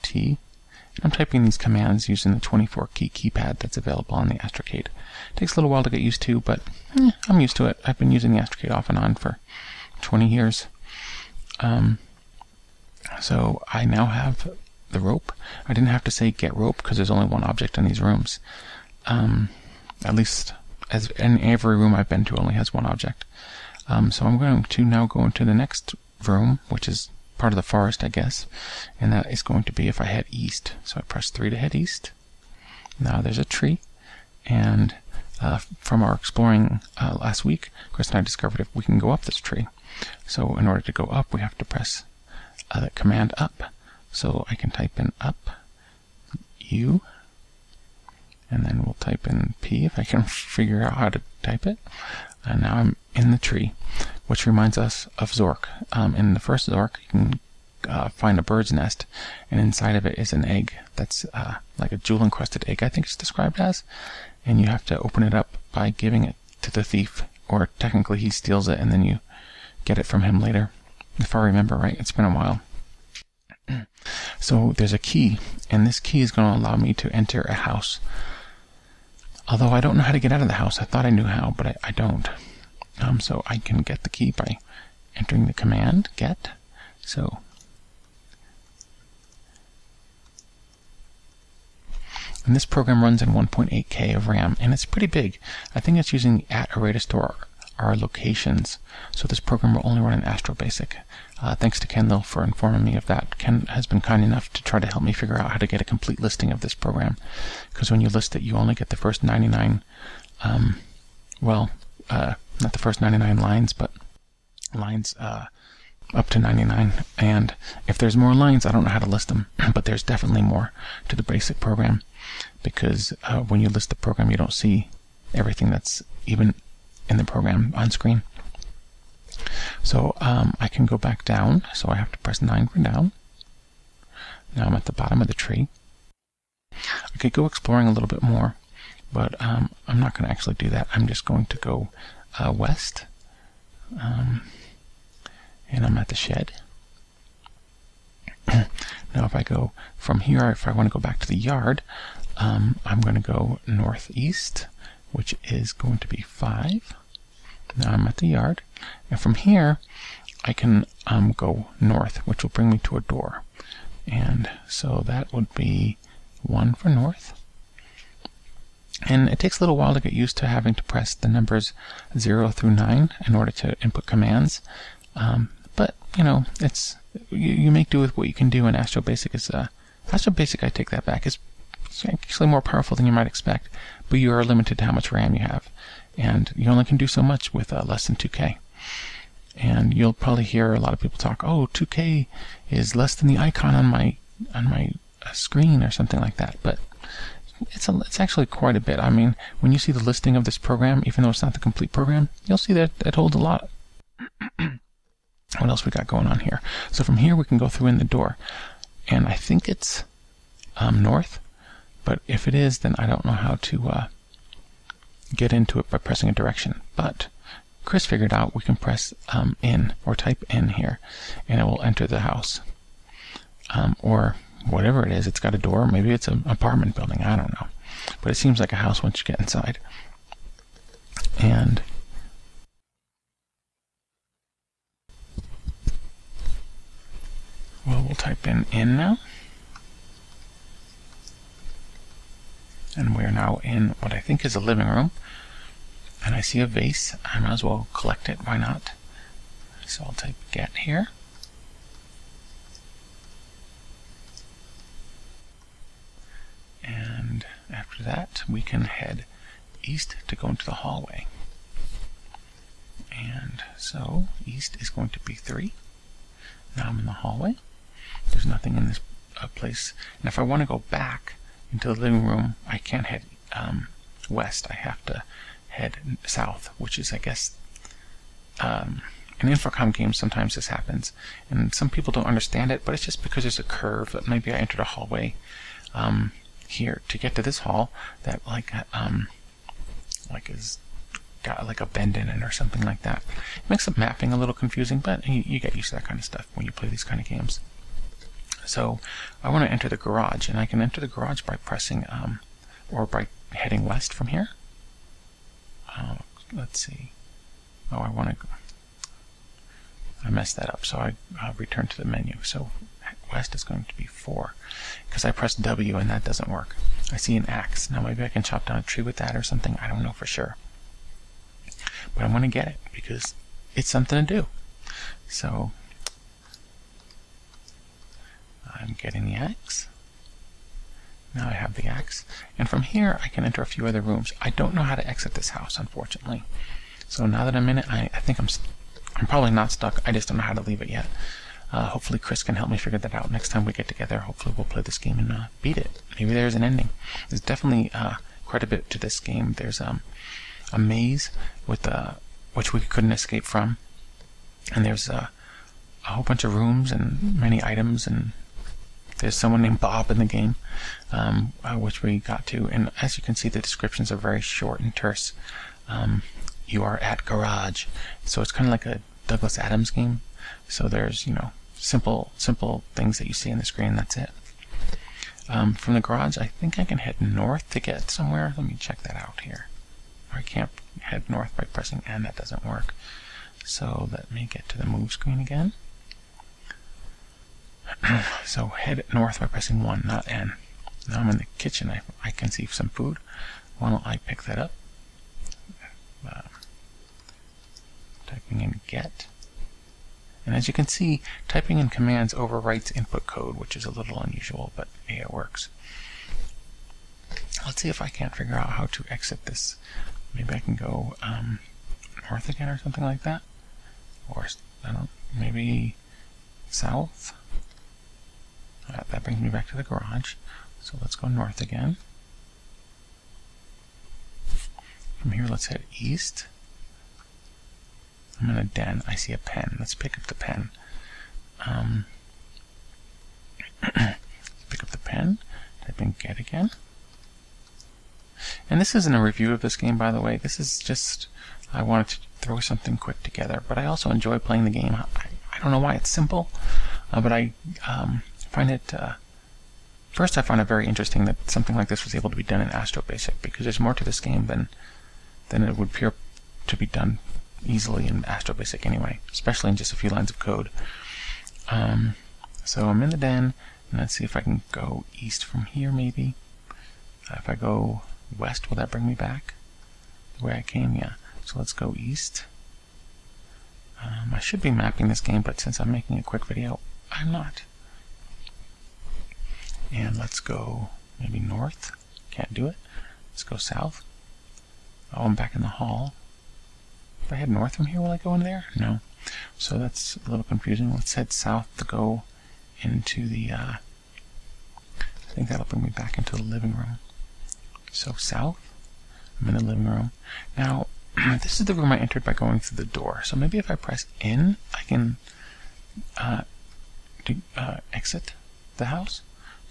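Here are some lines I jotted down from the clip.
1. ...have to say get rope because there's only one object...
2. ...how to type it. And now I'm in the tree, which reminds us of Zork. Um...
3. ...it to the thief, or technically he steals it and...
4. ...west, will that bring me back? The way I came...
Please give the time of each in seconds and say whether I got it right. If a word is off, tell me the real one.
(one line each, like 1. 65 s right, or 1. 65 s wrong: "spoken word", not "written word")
1. 15 s right
2. 50 s right
3. 66 s right
4. 468 s right.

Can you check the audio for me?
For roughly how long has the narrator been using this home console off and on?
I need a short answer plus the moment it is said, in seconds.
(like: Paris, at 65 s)
20 years, at 10 s.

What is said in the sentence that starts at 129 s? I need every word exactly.
So um, I can go back down, so I have to press 9 for down.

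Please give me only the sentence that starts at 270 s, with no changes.
And if I want to go back, into the living room.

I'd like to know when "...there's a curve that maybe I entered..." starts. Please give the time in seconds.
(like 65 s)
283 s.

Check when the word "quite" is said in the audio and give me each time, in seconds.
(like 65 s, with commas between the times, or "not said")
198 s, 348 s.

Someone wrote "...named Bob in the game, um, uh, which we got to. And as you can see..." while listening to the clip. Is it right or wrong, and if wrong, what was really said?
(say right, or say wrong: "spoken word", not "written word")
right.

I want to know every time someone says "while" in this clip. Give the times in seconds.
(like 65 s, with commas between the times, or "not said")
5 s, 72 s, 169 s.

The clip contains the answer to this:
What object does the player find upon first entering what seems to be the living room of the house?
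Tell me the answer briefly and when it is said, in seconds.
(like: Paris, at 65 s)
A vase, at 246 s.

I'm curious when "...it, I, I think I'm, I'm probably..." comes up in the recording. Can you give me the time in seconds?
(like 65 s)
337 s.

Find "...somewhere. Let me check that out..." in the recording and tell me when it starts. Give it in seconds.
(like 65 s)
378 s.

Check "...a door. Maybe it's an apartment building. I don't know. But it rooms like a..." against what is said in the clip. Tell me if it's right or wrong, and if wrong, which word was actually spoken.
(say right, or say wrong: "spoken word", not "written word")
wrong: "seems", not "rooms".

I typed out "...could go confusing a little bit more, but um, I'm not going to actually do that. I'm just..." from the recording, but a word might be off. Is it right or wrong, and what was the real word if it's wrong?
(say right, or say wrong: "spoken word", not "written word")
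wrong: "exploring", not "confusing".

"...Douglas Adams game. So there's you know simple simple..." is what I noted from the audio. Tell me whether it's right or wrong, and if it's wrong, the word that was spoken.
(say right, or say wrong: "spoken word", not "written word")
right.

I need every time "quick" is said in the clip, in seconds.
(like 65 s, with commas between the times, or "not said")
442 s, 476 s.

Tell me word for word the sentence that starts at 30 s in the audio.
So I press 3 to head east.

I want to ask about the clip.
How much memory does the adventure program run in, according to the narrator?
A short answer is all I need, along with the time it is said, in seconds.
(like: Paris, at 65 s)
1.8K, at 93 s.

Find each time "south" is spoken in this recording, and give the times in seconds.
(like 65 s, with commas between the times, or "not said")
276 s, 416 s, 483 s, 491 s, 498 s.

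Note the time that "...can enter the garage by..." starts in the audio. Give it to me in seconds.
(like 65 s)
300 s.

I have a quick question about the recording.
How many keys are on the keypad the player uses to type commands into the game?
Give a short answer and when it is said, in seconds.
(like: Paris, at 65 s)
24, at 2 s.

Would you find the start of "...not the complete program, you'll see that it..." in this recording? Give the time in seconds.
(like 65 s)
201 s.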